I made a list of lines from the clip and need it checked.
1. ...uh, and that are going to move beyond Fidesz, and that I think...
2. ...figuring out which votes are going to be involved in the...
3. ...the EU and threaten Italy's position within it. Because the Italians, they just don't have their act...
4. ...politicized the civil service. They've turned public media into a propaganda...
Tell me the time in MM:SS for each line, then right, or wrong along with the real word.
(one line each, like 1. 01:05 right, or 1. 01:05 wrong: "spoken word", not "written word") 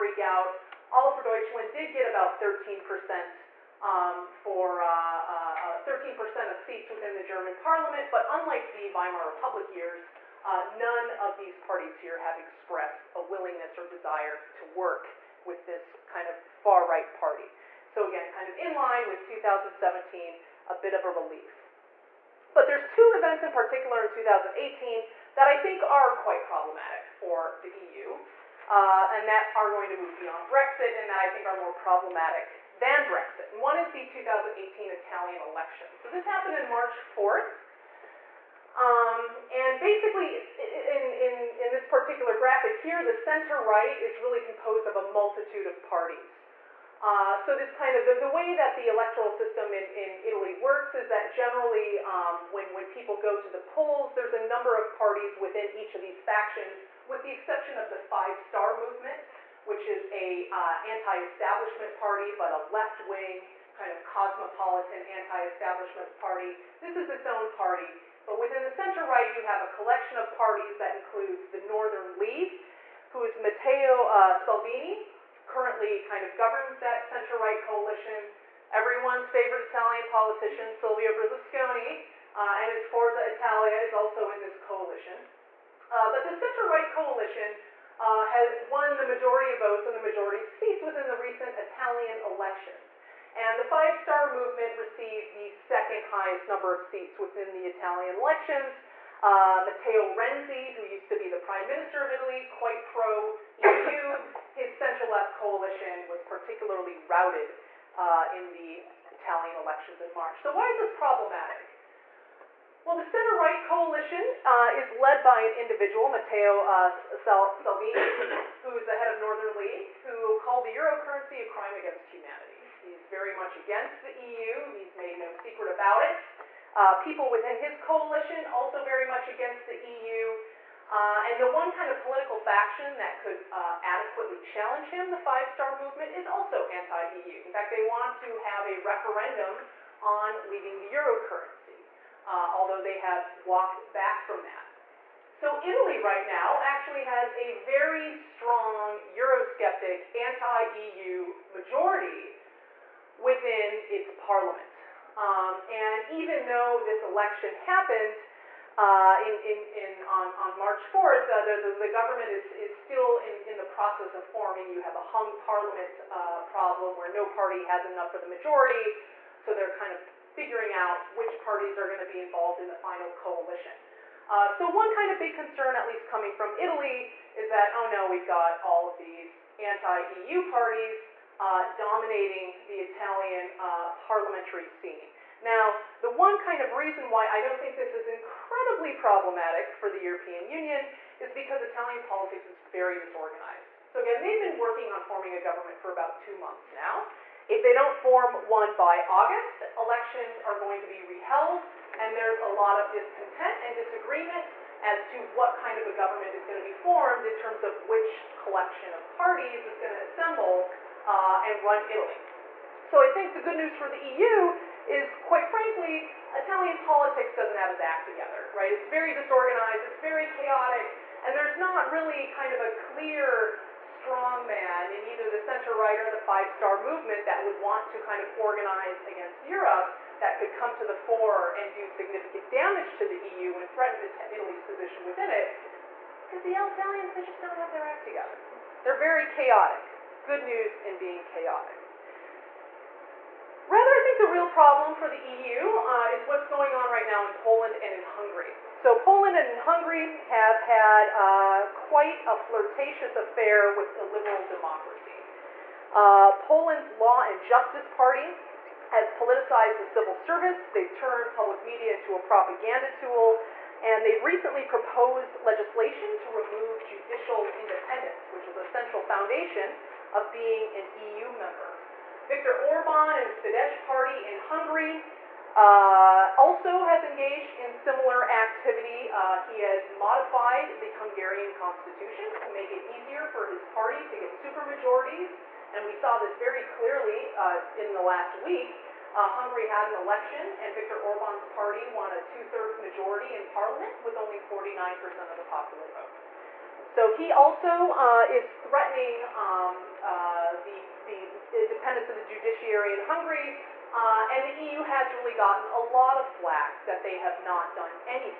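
1. 00:28 wrong: "Brexit", not "Fidesz"
2. 02:50 wrong: "parties", not "votes"
3. 03:53 right
4. 04:19 right.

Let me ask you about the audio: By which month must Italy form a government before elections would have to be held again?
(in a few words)
August.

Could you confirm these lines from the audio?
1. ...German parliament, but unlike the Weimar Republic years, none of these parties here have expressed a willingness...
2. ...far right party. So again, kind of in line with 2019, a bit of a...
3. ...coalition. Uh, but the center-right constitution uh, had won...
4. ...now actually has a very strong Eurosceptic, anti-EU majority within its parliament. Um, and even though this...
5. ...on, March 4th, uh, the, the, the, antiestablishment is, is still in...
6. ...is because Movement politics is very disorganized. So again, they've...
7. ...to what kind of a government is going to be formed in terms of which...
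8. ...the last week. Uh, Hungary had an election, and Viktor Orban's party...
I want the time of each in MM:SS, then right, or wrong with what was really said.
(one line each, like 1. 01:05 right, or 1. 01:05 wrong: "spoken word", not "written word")
1. 00:07 right
2. 00:16 wrong: "2017", not "2019"
3. 01:24 wrong: "coalition", not "constitution"
4. 02:26 right
5. 02:40 wrong: "government", not "antiestablishment"
6. 03:11 wrong: "Italian", not "Movement"
7. 03:25 right
8. 04:47 right.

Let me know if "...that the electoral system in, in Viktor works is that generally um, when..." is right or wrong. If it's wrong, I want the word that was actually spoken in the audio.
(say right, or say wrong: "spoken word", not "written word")
wrong: "Italy", not "Viktor".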